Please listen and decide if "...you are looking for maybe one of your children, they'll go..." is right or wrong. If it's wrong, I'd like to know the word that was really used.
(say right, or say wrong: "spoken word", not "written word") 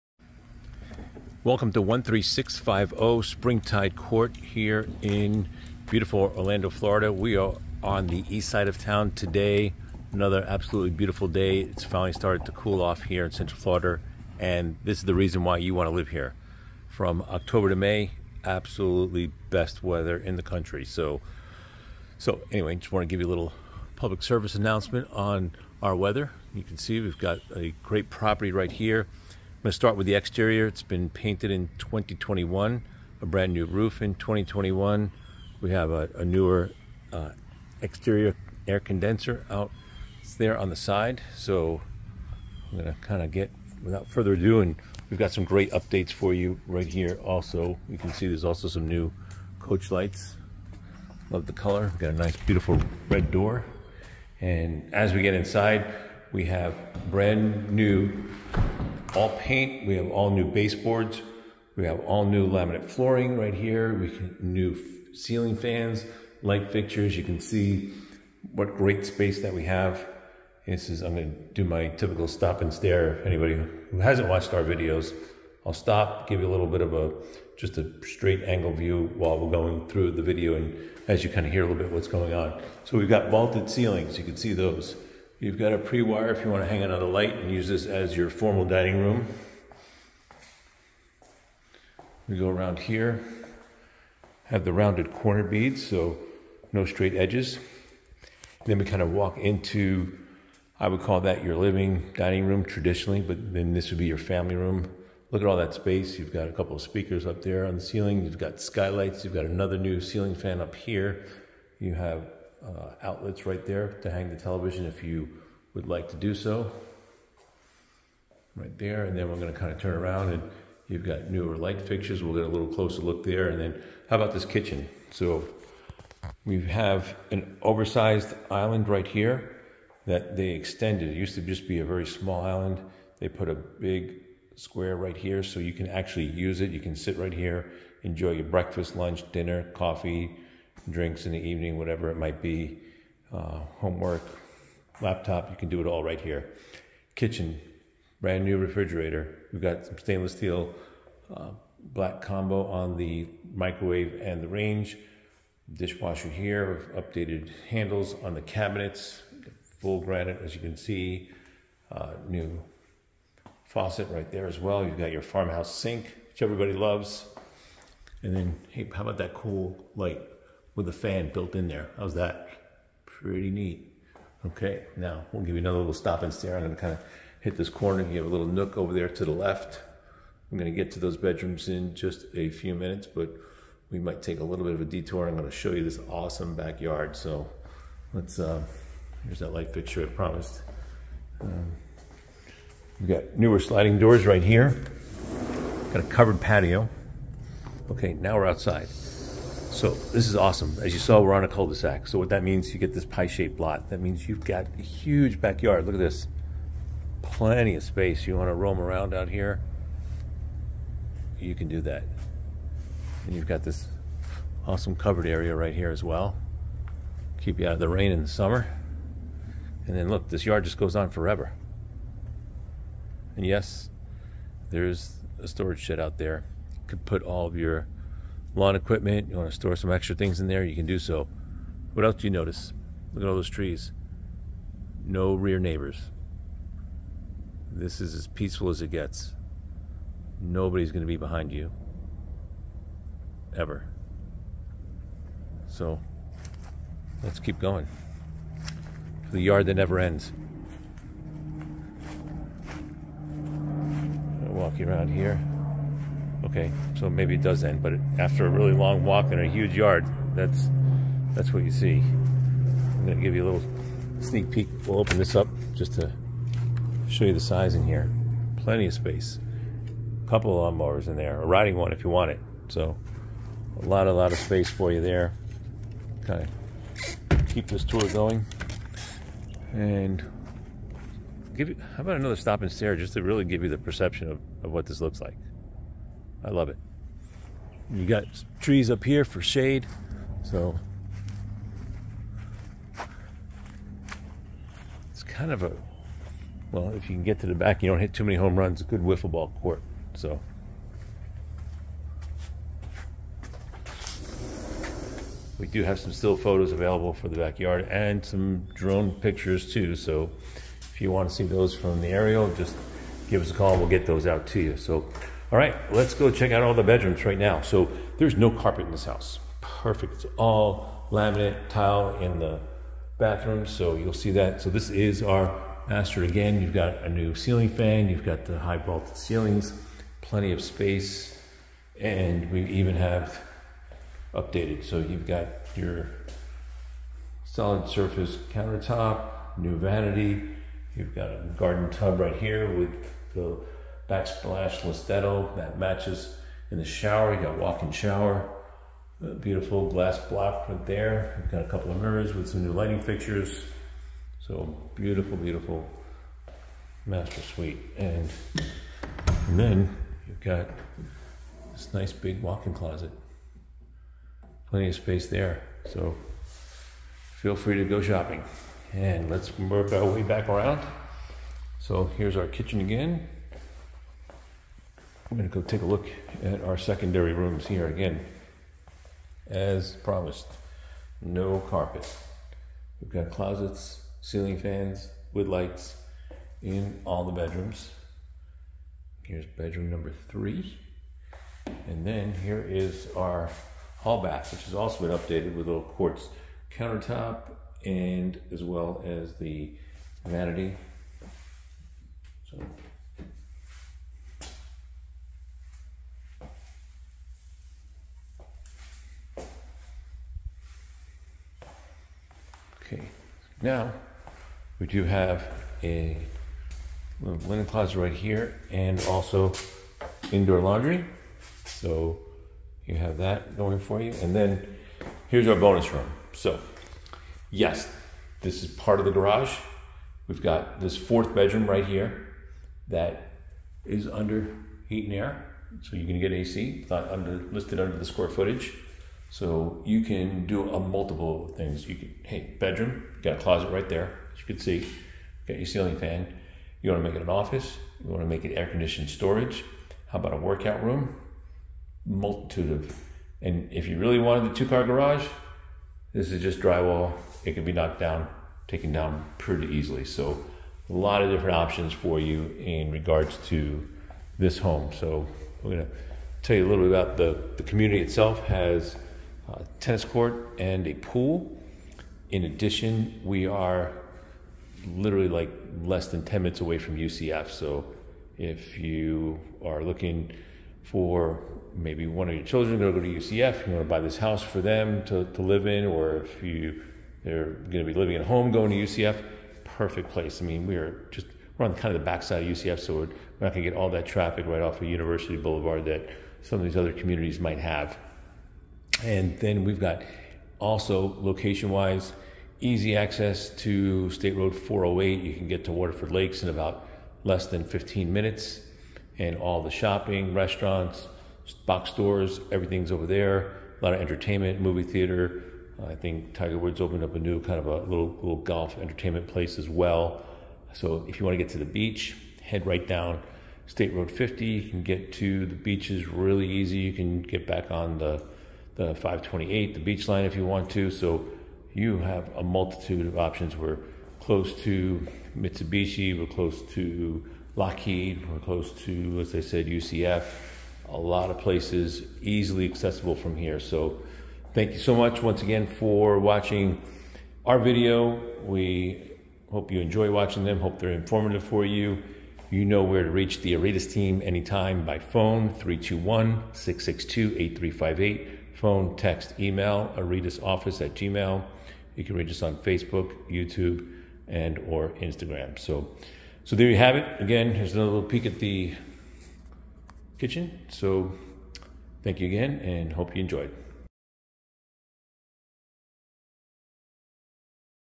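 right.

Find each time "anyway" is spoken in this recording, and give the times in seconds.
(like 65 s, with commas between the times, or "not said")
22 s.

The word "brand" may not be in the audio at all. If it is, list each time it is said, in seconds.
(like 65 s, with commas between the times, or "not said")
33 s, 57 s, 148 s.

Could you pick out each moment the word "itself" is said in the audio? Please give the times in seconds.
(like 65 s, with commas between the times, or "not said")
468 s.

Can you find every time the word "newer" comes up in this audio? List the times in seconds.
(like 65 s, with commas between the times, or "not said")
36 s, 121 s, 193 s.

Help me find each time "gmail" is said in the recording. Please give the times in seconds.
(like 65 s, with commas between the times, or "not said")
560 s.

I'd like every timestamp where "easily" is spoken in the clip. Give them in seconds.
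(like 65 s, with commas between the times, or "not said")
459 s, 542 s.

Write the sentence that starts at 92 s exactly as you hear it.
We go around here, have the rounded corner beads, so no straight edges.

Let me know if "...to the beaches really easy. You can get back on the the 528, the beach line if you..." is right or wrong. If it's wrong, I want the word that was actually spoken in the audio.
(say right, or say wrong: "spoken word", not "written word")
right.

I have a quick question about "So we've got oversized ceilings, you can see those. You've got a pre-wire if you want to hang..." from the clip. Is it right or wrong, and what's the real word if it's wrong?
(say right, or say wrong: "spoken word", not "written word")
wrong: "vaulted", not "oversized".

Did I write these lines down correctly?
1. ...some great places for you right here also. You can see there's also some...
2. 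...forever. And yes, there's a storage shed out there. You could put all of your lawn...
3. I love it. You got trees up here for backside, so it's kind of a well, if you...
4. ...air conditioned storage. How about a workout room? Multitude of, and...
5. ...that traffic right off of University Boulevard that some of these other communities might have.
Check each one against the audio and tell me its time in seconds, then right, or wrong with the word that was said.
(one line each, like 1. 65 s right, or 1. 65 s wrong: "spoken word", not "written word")
1. 45 s wrong: "updates", not "places"
2. 221 s right
3. 286 s wrong: "shade", not "backside"
4. 448 s right
5. 493 s right.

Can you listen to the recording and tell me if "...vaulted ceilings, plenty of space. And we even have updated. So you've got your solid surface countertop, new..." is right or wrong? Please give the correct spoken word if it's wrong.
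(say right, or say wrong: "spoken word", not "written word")
right.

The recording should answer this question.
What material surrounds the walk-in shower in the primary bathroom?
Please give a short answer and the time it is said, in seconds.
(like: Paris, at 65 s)
Glass block, at 349 s.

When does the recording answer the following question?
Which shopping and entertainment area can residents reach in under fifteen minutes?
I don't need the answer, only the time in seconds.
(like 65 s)
505 s.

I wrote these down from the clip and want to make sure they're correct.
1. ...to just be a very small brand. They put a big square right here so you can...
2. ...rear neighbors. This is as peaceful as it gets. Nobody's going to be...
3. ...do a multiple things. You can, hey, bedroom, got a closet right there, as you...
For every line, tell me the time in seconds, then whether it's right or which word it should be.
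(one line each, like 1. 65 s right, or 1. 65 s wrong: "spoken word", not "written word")
1. 131 s wrong: "island", not "brand"
2. 235 s right
3. 440 s right.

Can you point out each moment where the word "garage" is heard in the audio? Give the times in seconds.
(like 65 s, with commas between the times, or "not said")
429 s, 454 s.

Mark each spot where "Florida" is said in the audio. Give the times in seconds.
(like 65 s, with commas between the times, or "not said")
6 s, 13 s.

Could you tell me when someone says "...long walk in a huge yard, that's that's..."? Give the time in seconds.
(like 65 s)
258 s.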